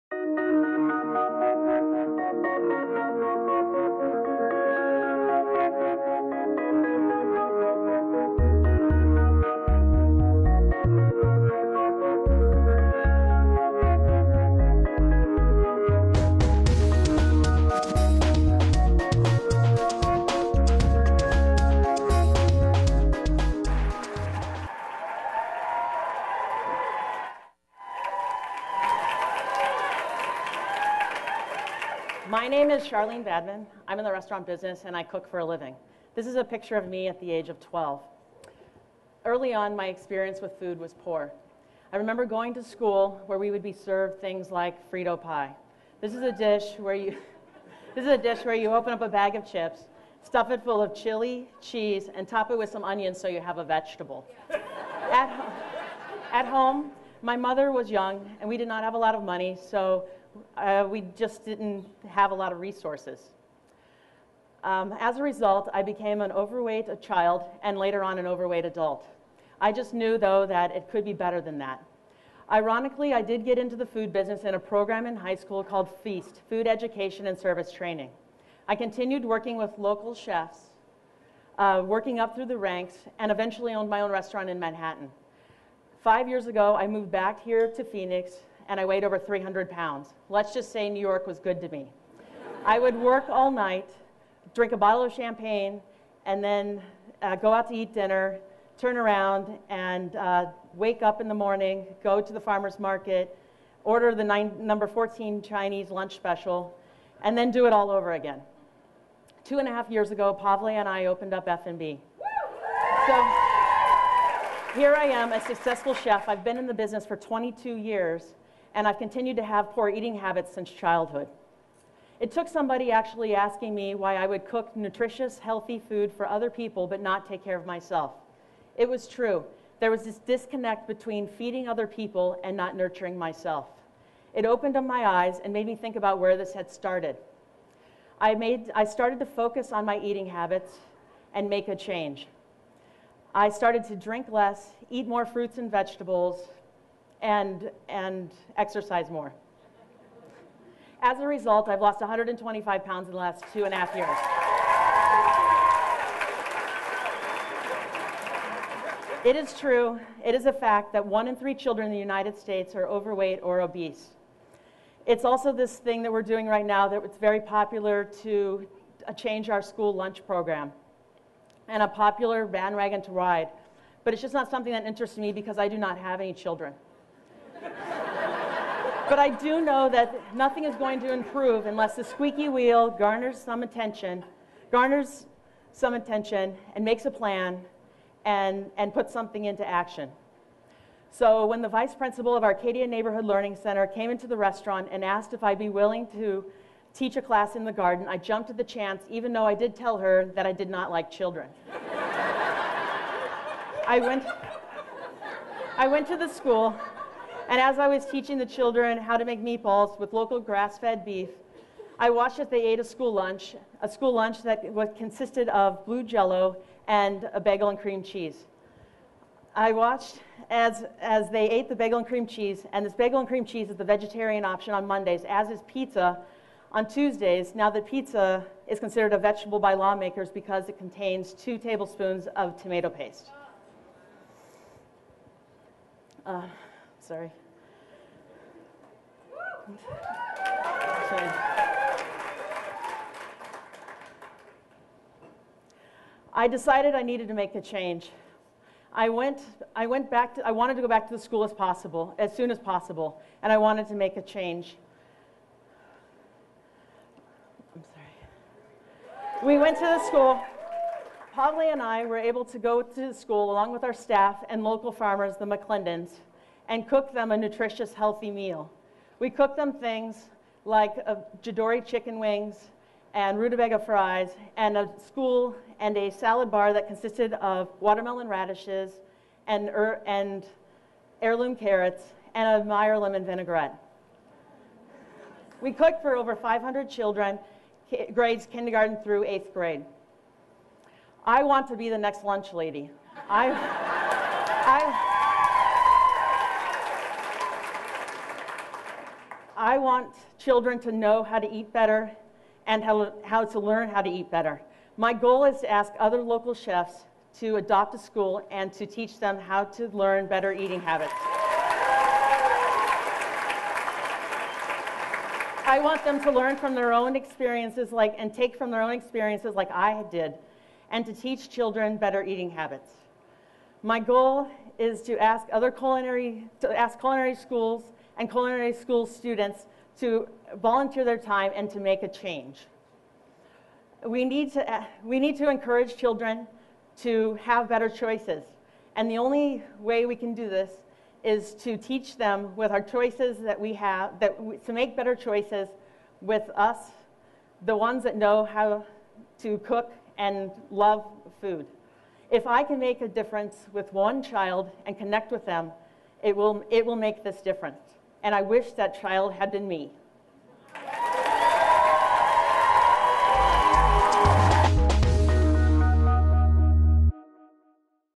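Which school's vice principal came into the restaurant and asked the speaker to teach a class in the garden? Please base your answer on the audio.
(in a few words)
Arcadia Neighborhood Learning Center.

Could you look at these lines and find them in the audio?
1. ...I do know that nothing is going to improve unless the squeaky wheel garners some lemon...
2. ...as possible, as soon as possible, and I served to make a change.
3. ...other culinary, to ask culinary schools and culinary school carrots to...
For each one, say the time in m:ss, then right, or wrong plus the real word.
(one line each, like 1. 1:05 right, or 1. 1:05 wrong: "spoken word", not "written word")
1. 2:59 wrong: "attention", not "lemon"
2. 4:11 wrong: "wanted", not "served"
3. 5:25 wrong: "students", not "carrots".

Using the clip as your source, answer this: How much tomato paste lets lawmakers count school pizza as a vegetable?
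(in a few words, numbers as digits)
2 tablespoons.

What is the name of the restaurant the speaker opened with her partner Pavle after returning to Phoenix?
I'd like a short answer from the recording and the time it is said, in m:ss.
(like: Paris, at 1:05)
F&B, at 1:51.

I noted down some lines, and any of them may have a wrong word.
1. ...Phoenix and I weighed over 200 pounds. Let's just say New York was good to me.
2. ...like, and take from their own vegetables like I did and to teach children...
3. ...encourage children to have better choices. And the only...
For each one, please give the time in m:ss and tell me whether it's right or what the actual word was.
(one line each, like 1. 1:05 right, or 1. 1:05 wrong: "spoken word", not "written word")
1. 1:27 wrong: "300", not "200"
2. 5:17 wrong: "experiences", not "vegetables"
3. 5:35 right.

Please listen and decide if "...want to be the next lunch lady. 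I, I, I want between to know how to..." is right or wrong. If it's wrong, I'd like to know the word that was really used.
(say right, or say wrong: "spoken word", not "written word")
wrong: "children", not "between".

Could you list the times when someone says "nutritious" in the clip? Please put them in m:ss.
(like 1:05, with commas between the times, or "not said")
2:04, 4:27.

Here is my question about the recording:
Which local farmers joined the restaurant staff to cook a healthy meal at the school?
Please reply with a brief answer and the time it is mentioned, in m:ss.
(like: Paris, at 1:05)
The McClendons, at 4:25.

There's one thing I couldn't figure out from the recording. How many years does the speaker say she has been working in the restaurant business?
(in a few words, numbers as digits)
22 years.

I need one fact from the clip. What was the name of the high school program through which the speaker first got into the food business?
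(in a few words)
FEAST.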